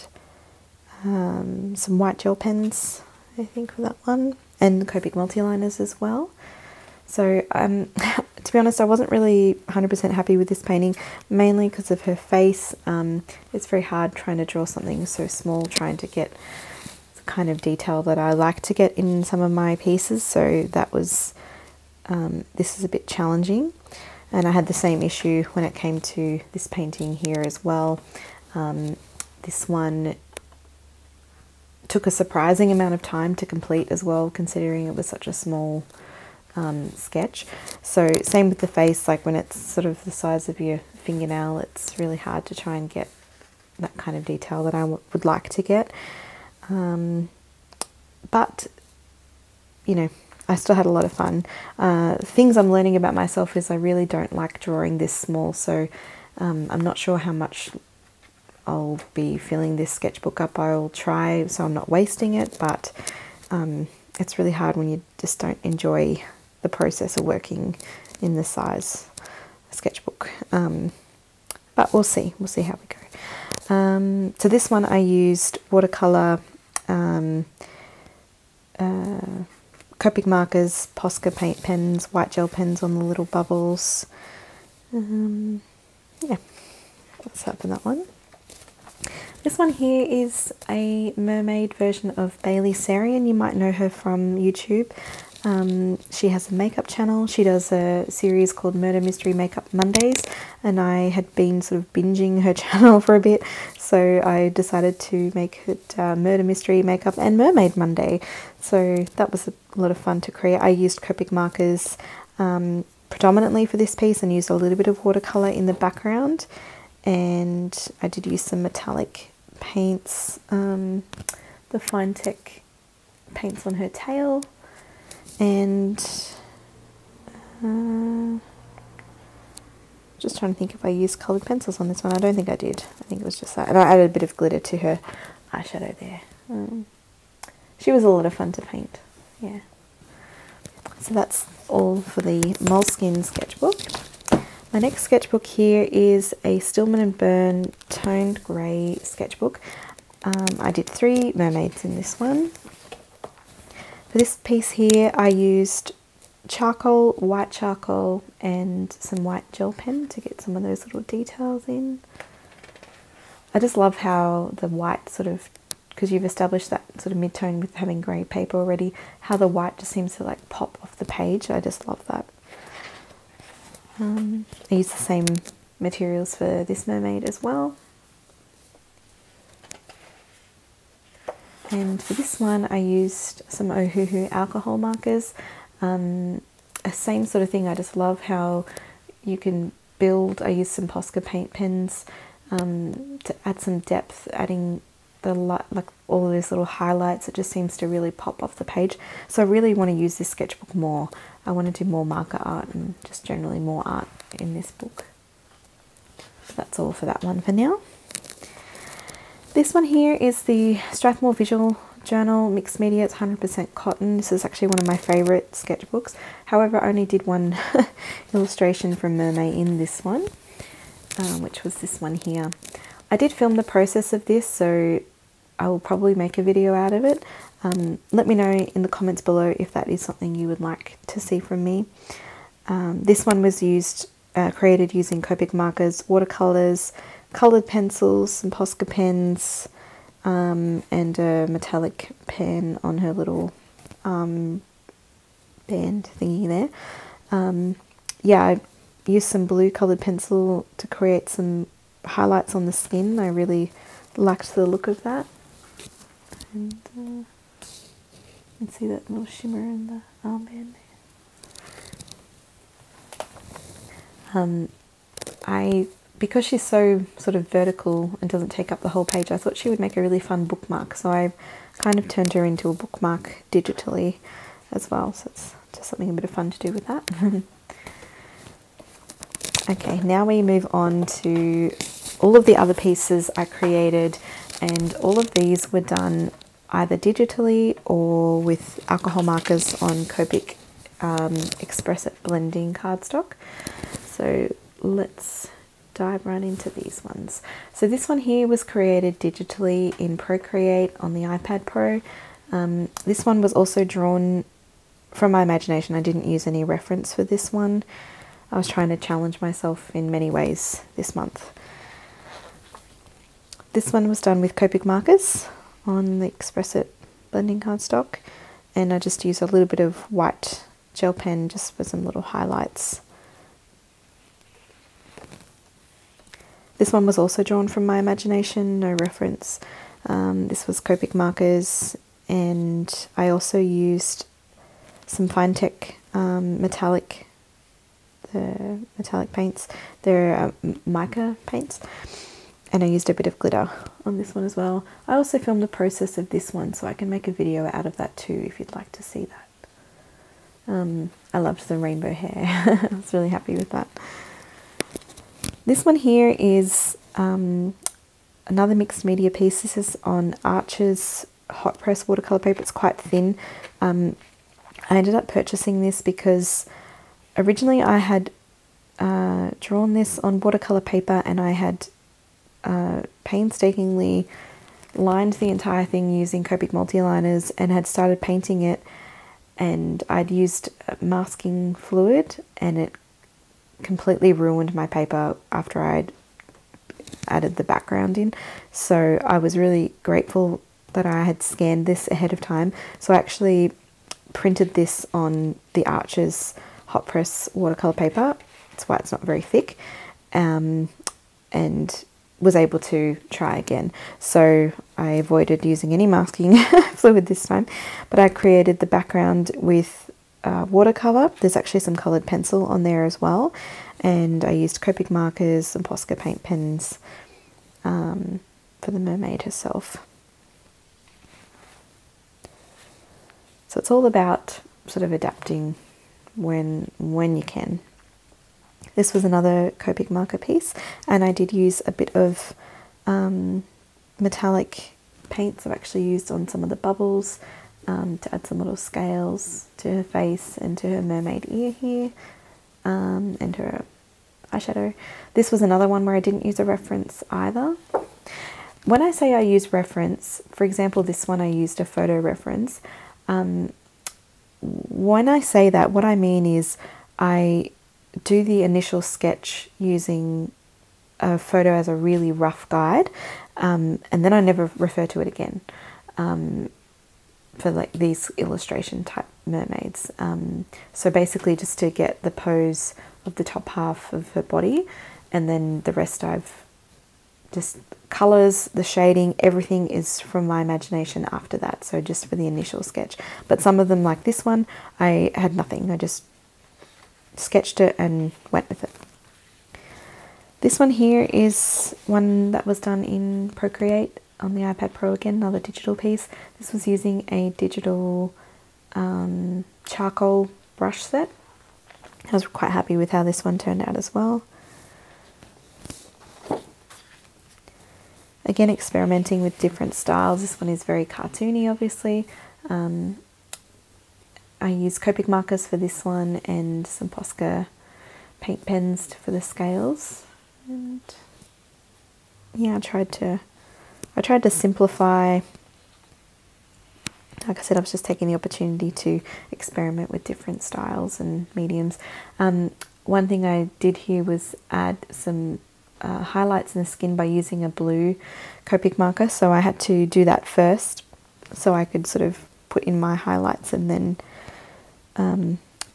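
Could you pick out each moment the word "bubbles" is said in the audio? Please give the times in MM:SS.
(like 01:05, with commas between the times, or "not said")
01:23, 07:16.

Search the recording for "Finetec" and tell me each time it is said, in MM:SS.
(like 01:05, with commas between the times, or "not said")
02:01, 05:35.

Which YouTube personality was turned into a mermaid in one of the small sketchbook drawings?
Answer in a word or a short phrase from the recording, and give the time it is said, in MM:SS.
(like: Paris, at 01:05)
Bailey Sarian, at 01:32.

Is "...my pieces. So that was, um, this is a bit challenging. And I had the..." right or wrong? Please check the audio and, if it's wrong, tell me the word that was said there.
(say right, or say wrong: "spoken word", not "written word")
right.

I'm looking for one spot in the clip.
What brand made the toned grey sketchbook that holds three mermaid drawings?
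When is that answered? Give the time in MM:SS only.
02:26.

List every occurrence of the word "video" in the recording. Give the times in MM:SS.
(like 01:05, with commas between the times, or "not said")
03:46, 05:47.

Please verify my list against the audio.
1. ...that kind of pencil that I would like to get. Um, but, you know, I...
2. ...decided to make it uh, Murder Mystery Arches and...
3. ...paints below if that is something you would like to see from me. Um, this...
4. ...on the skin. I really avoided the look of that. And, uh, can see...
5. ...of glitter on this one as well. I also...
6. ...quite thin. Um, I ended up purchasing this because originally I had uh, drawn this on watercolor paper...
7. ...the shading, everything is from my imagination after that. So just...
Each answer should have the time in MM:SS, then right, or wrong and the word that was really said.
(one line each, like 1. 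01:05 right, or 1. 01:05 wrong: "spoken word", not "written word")
1. 00:43 wrong: "detail", not "pencil"
2. 01:44 wrong: "Makeup", not "Arches"
3. 03:48 wrong: "comments", not "paints"
4. 04:12 wrong: "liked", not "avoided"
5. 05:43 right
6. 06:02 right
7. 07:58 right.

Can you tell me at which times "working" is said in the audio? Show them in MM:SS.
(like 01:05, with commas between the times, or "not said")
01:07.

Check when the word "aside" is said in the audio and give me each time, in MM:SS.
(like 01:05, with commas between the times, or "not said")
not said.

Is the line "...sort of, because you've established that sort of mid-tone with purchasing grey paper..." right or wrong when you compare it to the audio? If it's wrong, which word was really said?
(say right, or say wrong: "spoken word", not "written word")
wrong: "having", not "purchasing".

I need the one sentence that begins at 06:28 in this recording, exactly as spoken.
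So I was really grateful that I had scanned this ahead of time.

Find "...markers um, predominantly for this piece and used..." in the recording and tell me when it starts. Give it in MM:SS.
01:51.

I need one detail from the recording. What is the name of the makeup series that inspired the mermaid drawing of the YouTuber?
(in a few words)
Murder Mystery Makeup Mondays.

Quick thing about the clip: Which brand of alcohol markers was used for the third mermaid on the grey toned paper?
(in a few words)
Ohuhu.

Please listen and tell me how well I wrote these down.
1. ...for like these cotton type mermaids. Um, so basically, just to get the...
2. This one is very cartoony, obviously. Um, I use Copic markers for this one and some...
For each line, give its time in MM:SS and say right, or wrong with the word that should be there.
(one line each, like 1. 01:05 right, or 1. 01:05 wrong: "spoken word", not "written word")
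1. 07:47 wrong: "illustration", not "cotton"
2. 08:30 right.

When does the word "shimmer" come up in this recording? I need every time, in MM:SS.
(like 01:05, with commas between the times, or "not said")
04:19.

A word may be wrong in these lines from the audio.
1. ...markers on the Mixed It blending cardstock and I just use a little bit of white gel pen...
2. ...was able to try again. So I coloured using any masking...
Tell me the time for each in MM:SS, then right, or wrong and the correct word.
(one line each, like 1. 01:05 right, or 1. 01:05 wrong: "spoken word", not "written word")
1. 05:14 wrong: "Express", not "Mixed"
2. 06:42 wrong: "avoided", not "coloured".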